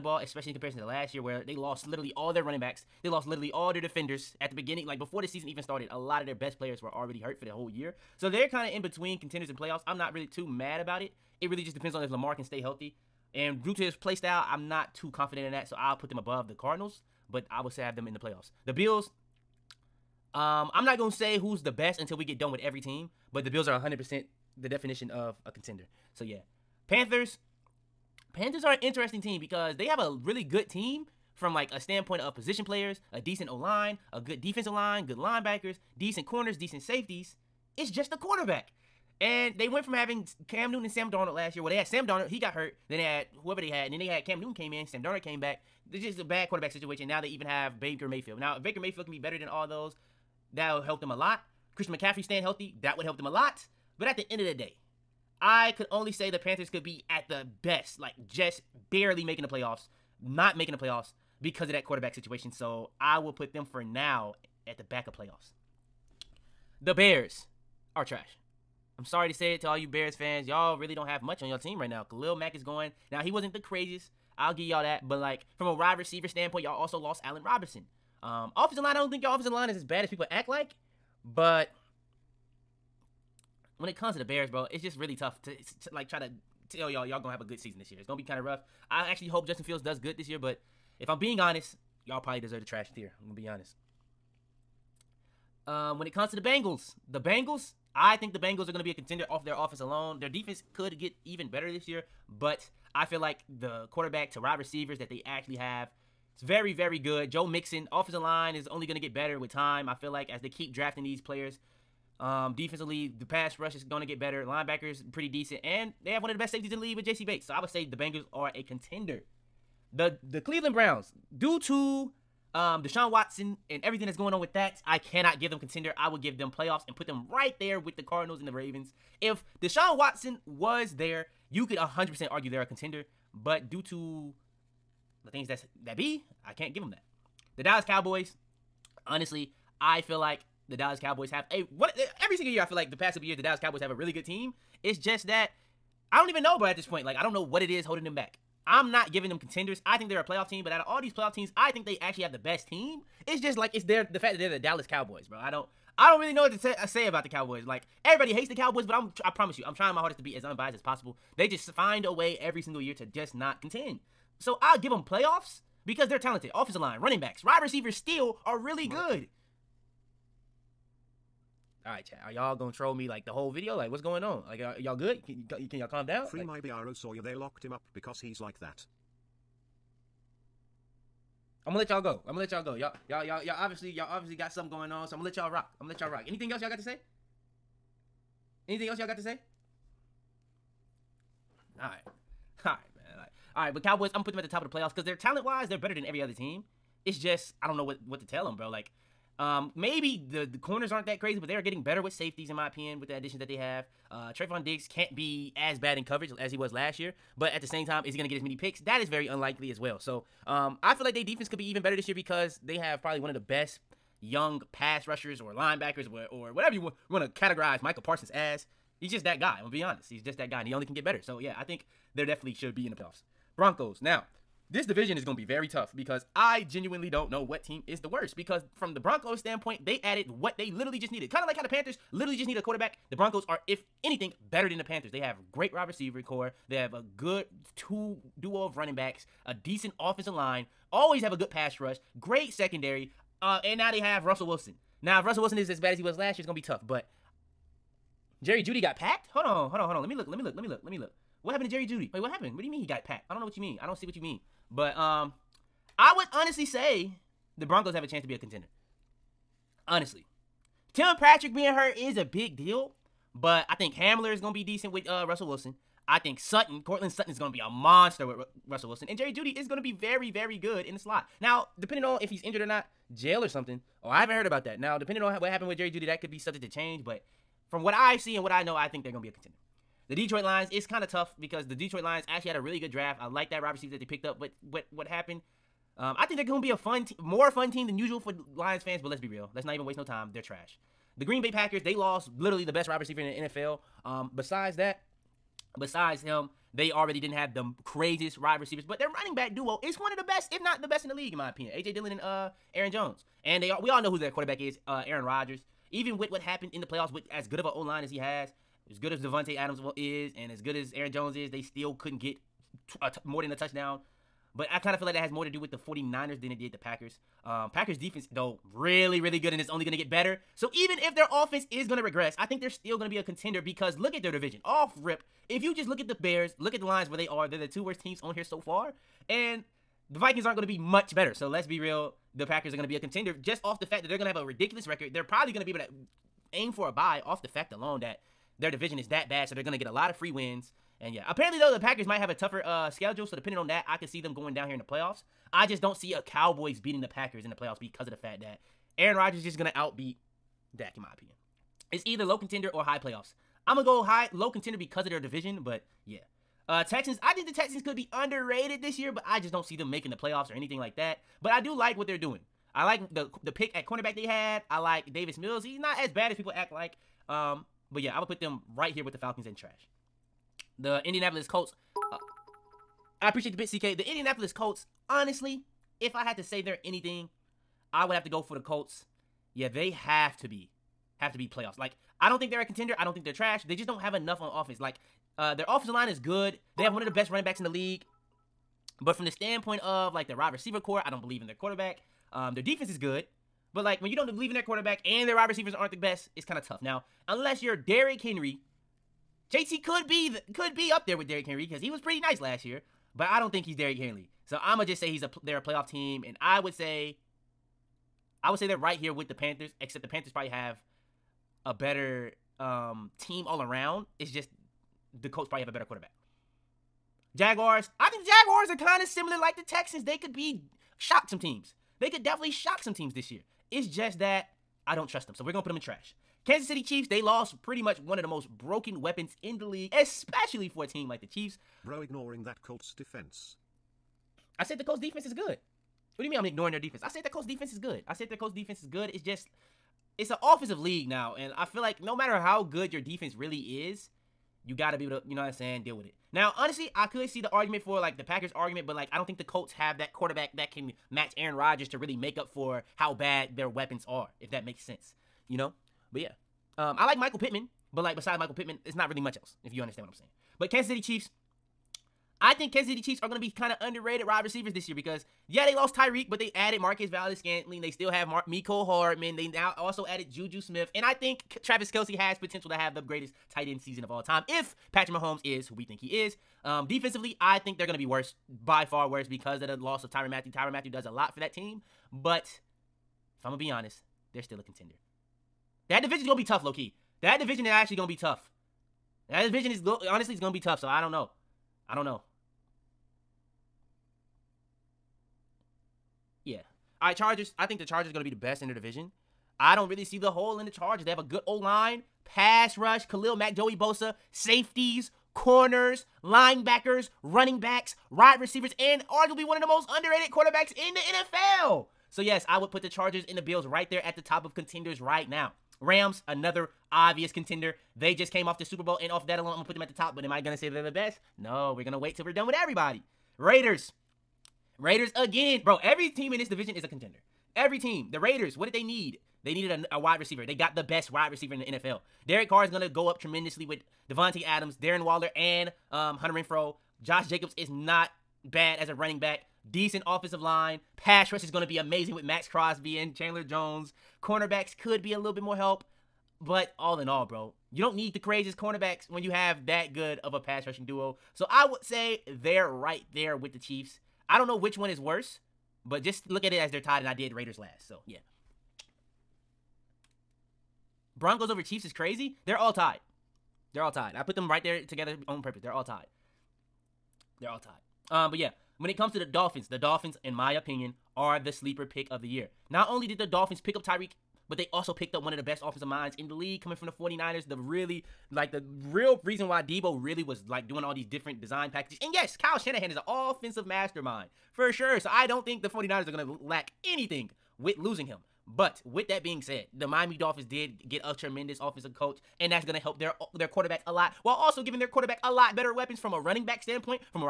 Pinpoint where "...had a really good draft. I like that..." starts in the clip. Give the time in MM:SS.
04:42.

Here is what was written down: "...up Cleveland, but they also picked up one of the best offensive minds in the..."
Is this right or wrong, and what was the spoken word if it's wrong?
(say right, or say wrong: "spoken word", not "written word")
wrong: "Tyreek", not "Cleveland".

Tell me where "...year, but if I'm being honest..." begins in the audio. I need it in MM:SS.
01:30.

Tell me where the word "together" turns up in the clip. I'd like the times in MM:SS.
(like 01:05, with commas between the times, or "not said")
09:24.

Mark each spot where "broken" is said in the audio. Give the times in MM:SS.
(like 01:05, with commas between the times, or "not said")
07:08.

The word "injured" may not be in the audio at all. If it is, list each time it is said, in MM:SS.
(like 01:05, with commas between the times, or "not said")
04:32.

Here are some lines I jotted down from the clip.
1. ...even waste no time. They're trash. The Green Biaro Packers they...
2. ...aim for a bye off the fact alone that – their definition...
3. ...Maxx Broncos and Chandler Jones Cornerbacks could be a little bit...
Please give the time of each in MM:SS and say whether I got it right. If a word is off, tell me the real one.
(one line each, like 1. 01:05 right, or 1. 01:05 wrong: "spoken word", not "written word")
1. 04:49 wrong: "Bay", not "Biaro"
2. 05:36 wrong: "division", not "definition"
3. 09:02 wrong: "Crosby", not "Broncos".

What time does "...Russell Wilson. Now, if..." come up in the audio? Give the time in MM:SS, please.
04:04.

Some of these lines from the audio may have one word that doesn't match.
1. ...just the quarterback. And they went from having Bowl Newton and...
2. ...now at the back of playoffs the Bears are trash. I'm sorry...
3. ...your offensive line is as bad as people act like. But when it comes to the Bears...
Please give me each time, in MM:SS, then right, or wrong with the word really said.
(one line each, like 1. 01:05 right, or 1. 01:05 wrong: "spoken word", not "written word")
1. 00:37 wrong: "Cam", not "Bowl"
2. 01:03 right
3. 01:19 right.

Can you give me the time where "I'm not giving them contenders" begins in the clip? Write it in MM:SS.
02:28.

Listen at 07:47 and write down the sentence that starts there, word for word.
They still have Mar- Mecole Hardman.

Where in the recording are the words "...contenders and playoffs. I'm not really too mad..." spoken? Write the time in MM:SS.
00:09.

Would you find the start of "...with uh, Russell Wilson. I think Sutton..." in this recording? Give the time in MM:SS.
04:24.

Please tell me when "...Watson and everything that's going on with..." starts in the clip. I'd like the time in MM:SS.
02:03.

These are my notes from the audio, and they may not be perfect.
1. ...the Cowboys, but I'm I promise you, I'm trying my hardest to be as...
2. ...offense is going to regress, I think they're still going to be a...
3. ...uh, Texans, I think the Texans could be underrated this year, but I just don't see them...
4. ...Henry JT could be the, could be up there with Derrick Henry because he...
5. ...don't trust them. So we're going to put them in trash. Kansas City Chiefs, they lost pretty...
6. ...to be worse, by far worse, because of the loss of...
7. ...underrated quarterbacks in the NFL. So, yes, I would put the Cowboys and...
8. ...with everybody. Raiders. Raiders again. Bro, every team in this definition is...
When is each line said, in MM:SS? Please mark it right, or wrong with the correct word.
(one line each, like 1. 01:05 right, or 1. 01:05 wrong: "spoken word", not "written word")
1. 02:38 right
2. 05:21 right
3. 05:56 right
4. 06:38 right
5. 07:04 right
6. 07:57 right
7. 08:29 wrong: "Chargers", not "Cowboys"
8. 08:42 wrong: "division", not "definition".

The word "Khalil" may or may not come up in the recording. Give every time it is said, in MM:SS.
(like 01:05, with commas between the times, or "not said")
01:12, 08:23.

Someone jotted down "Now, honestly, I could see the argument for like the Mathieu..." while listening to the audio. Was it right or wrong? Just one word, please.
wrong.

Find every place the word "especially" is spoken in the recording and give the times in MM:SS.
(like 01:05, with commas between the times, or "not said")
00:00, 07:09.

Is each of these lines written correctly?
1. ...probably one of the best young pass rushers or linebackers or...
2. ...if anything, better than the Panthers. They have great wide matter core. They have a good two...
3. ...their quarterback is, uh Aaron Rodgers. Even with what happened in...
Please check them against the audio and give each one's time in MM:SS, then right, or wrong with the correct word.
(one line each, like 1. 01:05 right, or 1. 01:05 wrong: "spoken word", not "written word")
1. 03:33 right
2. 03:53 wrong: "receiver", not "matter"
3. 05:04 right.